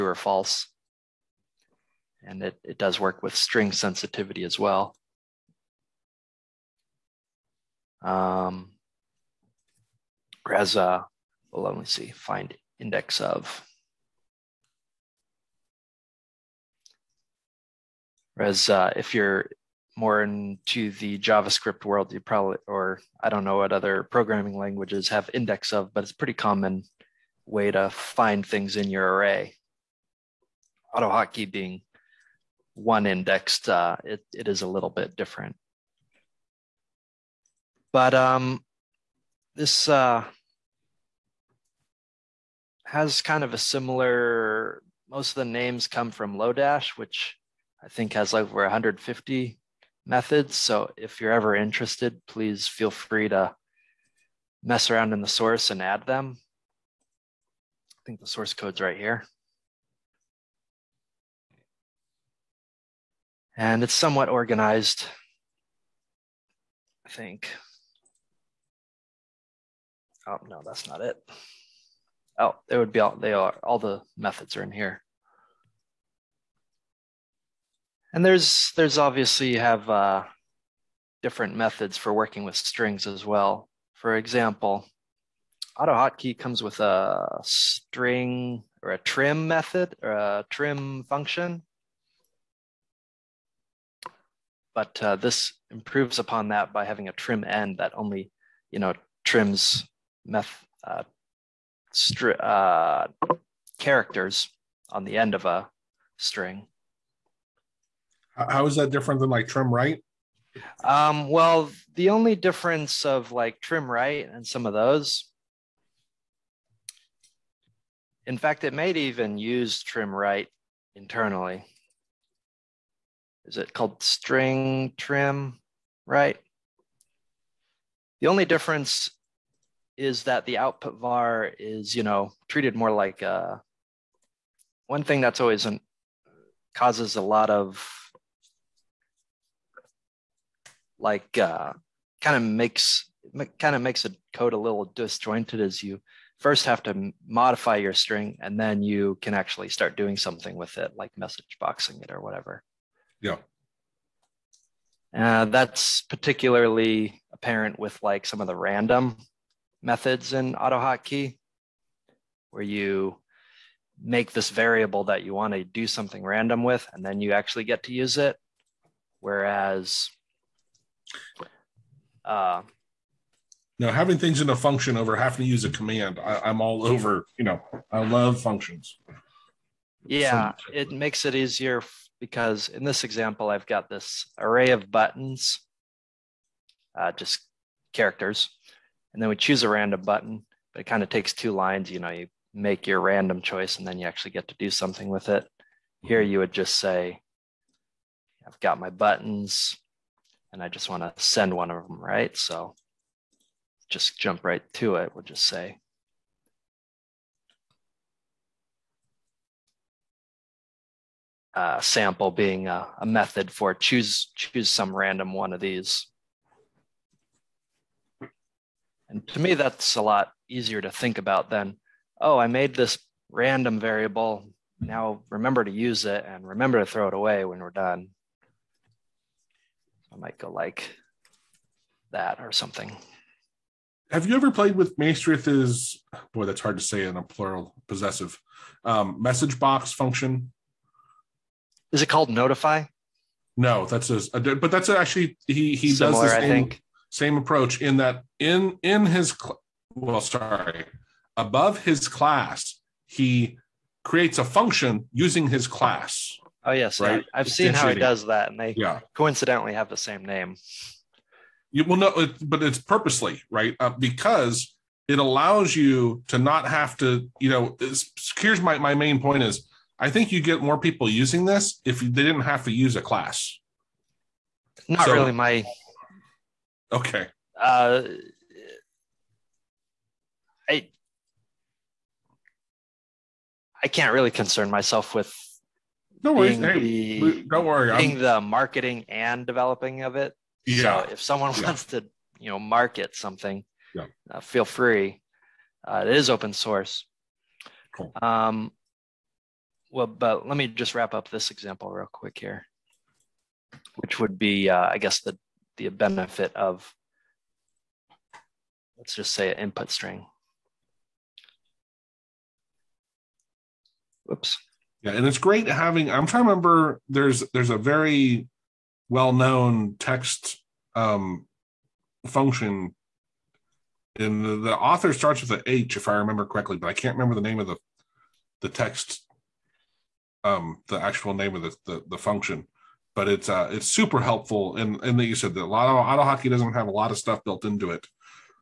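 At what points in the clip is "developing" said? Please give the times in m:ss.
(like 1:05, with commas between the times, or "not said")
4:49.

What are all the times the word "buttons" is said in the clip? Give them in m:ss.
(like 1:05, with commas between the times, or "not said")
3:04, 3:10, 3:18.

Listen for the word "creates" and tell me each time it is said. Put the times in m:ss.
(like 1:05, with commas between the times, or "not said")
4:14.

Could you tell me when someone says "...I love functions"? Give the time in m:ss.
2:57.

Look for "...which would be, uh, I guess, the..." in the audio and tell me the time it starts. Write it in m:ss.
5:03.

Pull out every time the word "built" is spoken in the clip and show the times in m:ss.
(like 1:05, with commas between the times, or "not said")
5:37.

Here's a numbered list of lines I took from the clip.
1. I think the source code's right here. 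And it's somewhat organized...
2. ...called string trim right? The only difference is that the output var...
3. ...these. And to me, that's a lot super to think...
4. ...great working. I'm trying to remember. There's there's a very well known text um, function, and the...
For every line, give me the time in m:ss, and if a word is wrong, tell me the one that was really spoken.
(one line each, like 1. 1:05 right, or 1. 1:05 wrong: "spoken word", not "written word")
1. 0:57 right
2. 2:03 right
3. 3:35 wrong: "easier", not "super"
4. 5:15 wrong: "having", not "working".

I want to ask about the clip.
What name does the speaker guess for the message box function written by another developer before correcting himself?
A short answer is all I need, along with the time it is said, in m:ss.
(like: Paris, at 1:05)
notify, at 4:02.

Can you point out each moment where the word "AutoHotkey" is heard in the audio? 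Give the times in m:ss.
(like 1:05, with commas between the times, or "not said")
0:30, 1:25, 2:40, 5:36.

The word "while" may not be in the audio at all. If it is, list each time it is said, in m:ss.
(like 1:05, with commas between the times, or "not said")
not said.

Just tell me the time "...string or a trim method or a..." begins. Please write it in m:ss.
1:27.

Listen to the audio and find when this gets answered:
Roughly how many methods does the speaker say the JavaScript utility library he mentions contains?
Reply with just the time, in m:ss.
0:48.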